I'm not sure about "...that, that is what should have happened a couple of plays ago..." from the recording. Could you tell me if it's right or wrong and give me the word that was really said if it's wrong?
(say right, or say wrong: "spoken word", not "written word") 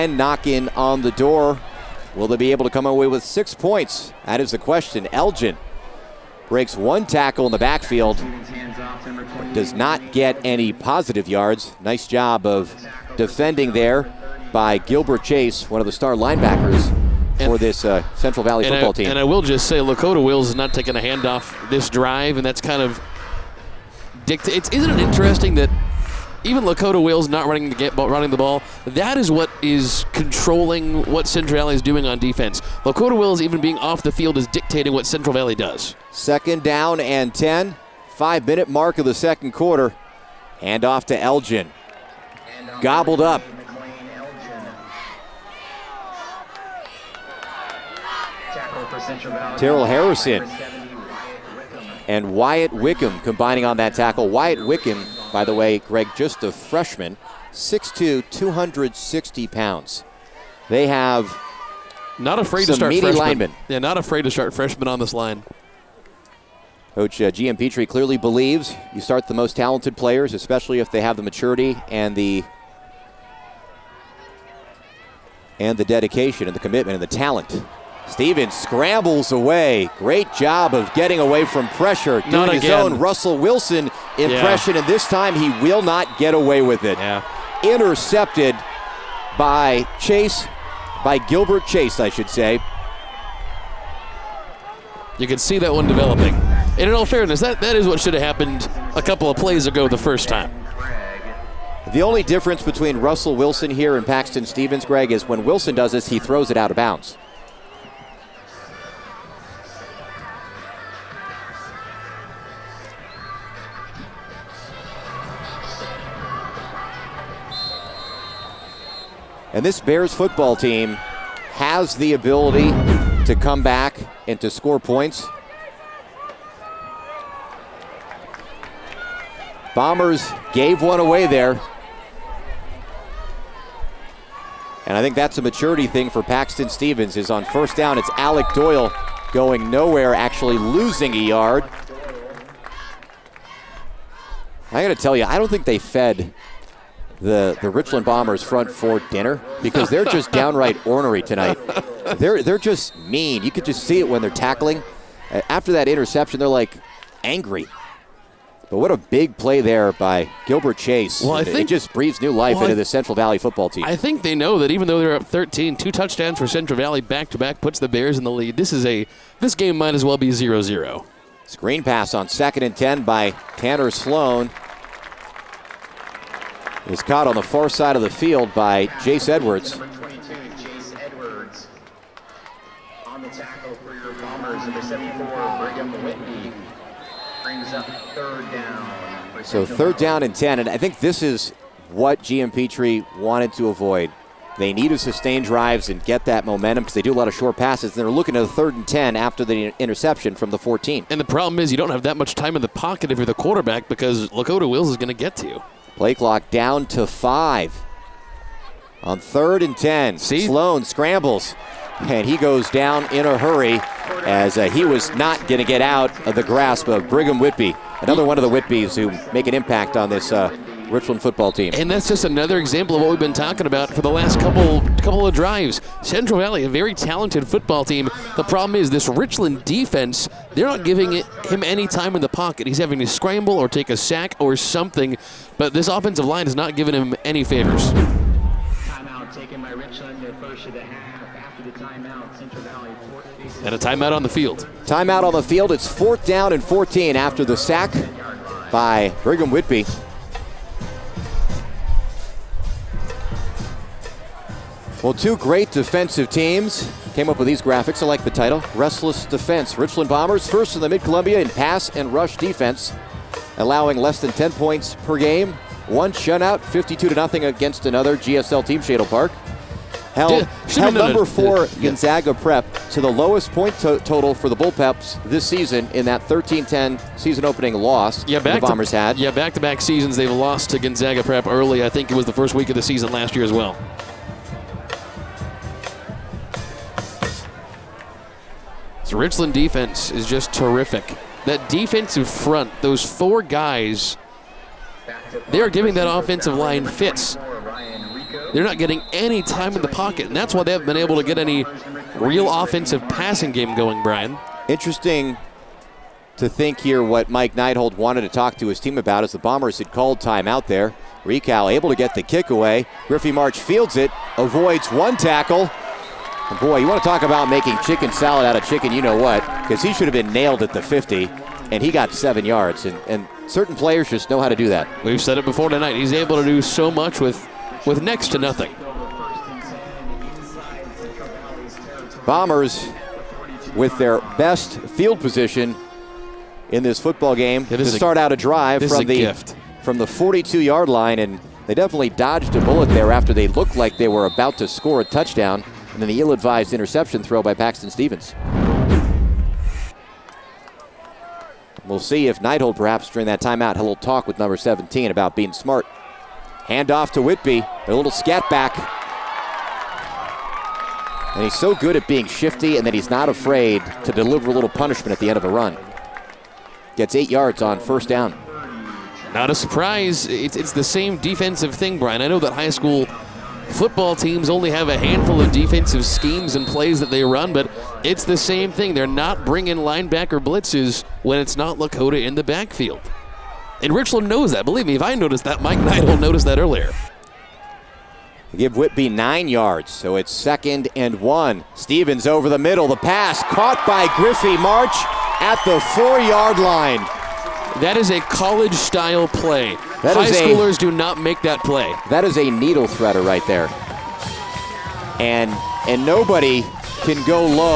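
right.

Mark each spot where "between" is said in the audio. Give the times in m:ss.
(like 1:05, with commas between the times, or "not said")
1:42.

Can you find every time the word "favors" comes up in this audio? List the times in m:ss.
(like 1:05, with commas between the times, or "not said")
3:57.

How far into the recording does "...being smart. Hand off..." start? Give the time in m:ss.
5:55.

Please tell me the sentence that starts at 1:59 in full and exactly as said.
And this Bears football team has the ability to come back and to score points.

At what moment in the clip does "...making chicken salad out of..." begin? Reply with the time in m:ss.
5:17.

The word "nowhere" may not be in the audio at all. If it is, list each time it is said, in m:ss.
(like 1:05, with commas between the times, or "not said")
2:19.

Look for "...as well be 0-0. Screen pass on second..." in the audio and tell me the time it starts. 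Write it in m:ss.
2:49.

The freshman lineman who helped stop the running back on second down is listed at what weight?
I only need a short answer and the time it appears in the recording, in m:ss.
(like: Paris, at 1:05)
260 pounds, at 0:58.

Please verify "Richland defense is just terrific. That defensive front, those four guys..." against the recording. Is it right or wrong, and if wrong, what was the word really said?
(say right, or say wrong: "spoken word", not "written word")
right.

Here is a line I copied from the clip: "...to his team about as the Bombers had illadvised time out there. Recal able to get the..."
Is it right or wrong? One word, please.
wrong.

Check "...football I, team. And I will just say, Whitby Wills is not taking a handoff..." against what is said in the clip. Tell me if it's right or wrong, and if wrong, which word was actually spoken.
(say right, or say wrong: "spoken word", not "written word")
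wrong: "Lakota", not "Whitby".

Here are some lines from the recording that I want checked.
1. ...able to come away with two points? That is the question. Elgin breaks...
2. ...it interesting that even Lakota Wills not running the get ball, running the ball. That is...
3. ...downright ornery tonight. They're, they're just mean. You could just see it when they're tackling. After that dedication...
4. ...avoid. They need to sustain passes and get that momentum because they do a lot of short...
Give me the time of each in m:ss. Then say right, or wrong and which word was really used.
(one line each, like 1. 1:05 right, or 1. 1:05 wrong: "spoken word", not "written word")
1. 0:02 wrong: "six", not "two"
2. 0:24 right
3. 2:30 wrong: "interception", not "dedication"
4. 3:13 wrong: "drives", not "passes".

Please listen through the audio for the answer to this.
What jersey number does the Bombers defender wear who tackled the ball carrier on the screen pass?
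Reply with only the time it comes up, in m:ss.
3:04.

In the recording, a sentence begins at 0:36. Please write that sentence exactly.
Second down and ten five minute mark of the second quarter.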